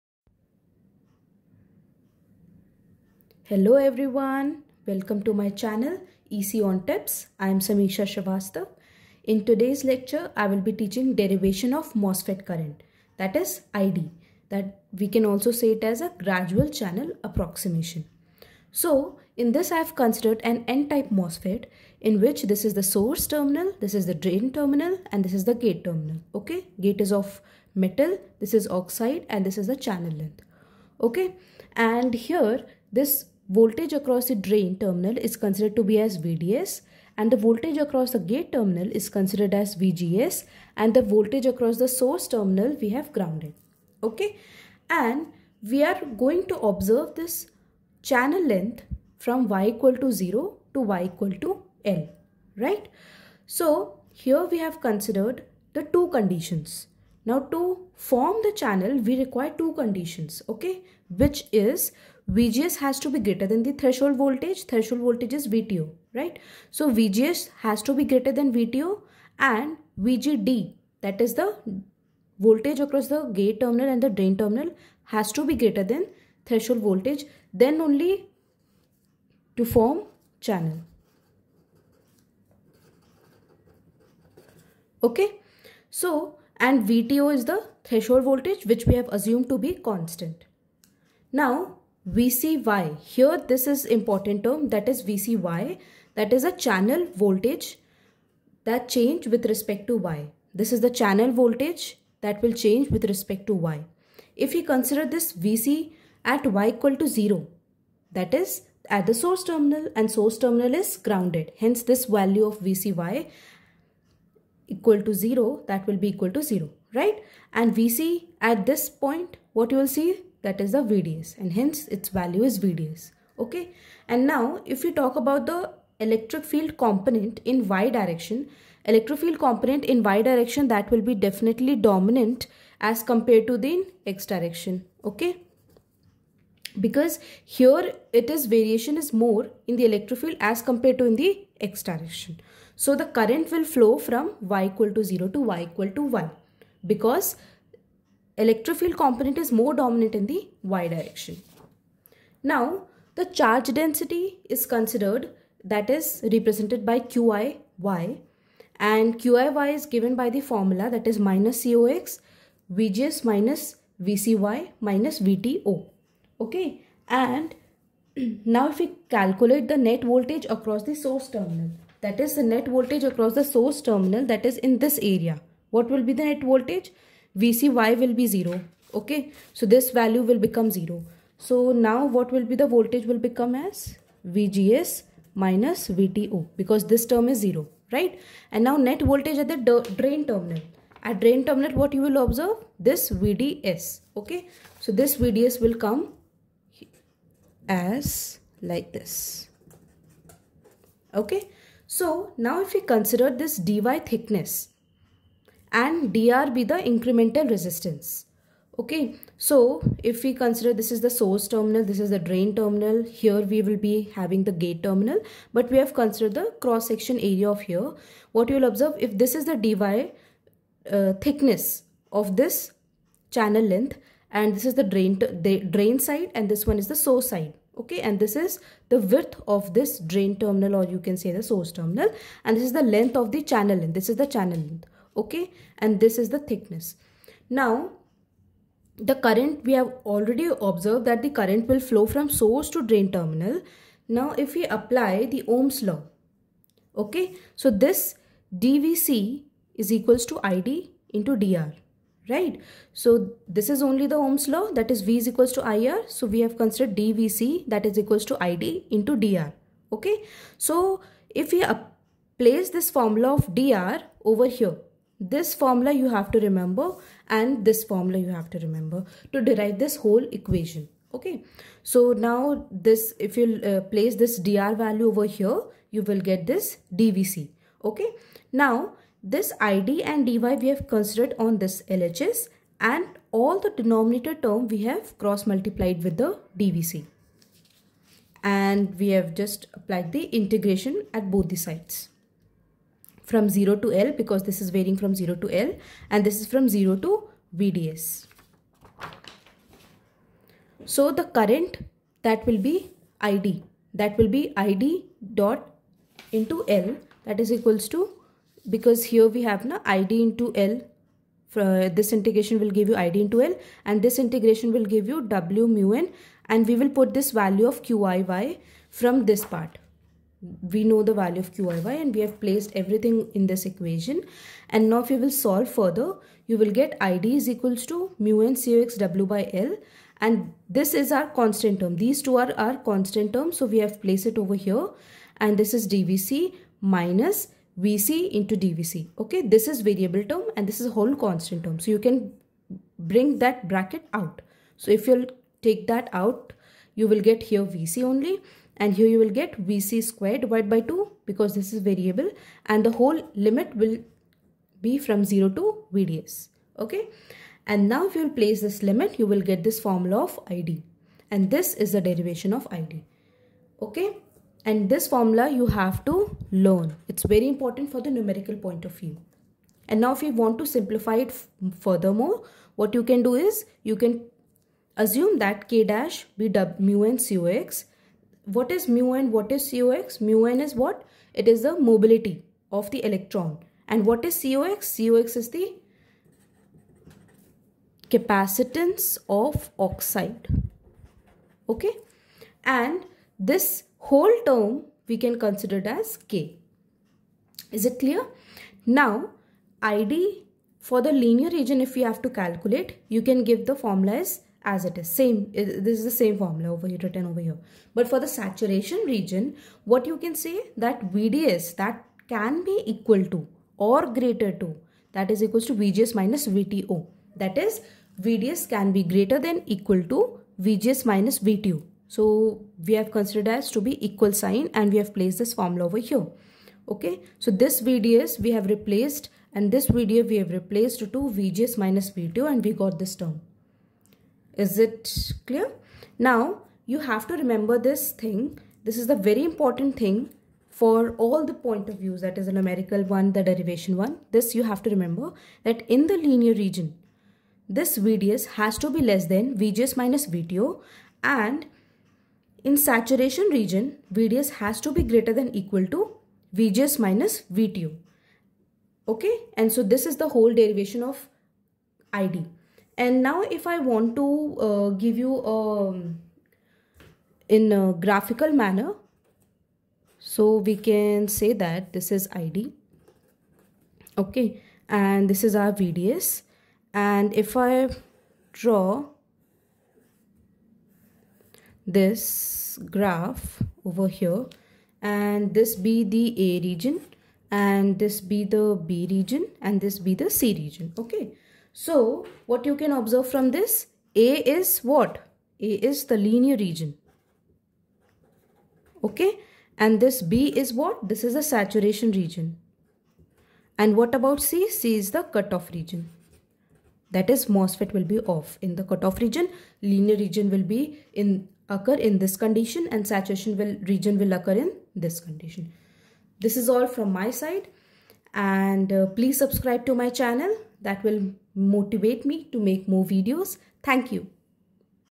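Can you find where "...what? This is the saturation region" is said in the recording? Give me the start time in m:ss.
8:20.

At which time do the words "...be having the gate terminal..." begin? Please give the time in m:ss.
3:33.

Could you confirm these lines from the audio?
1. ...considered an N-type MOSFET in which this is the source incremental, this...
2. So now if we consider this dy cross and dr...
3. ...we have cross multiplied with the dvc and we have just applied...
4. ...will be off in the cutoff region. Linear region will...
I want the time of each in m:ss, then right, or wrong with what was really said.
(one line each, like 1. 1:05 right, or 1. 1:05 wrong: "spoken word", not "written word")
1. 0:19 wrong: "terminal", not "incremental"
2. 3:21 wrong: "thickness", not "cross"
3. 4:44 right
4. 8:27 right.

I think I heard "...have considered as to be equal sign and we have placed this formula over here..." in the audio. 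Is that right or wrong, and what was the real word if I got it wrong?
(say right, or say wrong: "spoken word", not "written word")
right.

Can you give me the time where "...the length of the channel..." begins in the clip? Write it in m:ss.
3:52.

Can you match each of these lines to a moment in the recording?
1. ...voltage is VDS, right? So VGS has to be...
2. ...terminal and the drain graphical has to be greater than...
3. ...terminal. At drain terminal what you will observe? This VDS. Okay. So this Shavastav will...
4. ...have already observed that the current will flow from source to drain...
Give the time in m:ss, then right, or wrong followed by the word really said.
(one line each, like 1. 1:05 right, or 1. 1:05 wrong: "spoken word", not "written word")
1. 1:05 wrong: "VTO", not "VDS"
2. 1:13 wrong: "terminal", not "graphical"
3. 3:10 wrong: "VDS", not "Shavastav"
4. 3:59 right.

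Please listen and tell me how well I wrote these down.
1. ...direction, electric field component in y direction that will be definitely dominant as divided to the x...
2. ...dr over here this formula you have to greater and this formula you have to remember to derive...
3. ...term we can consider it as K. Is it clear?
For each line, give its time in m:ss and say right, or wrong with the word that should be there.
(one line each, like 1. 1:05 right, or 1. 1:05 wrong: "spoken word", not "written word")
1. 2:07 wrong: "compared", not "divided"
2. 4:23 wrong: "remember", not "greater"
3. 6:34 right.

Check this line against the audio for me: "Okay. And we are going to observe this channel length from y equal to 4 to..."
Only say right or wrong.
wrong.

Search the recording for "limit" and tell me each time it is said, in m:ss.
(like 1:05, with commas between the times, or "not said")
5:53, 5:58.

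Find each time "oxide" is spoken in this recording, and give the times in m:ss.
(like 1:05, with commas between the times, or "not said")
0:28, 6:29.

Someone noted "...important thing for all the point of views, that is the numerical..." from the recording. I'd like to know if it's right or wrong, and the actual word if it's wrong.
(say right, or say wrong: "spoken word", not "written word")
right.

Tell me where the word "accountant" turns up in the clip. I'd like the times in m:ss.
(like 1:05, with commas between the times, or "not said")
not said.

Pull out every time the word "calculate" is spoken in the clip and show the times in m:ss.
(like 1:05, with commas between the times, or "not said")
2:49, 6:42.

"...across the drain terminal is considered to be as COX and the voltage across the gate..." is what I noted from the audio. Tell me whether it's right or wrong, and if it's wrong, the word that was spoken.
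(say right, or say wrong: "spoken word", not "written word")
wrong: "VDS", not "COX".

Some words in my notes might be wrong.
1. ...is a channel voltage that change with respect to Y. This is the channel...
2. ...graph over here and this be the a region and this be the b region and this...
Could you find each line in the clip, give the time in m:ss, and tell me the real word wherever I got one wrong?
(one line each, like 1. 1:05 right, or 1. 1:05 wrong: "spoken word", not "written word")
1. 1:36 right
2. 8:02 right.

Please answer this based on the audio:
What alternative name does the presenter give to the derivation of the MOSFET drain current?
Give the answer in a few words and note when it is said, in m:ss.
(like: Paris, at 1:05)
gradual channel approximation, at 0:16.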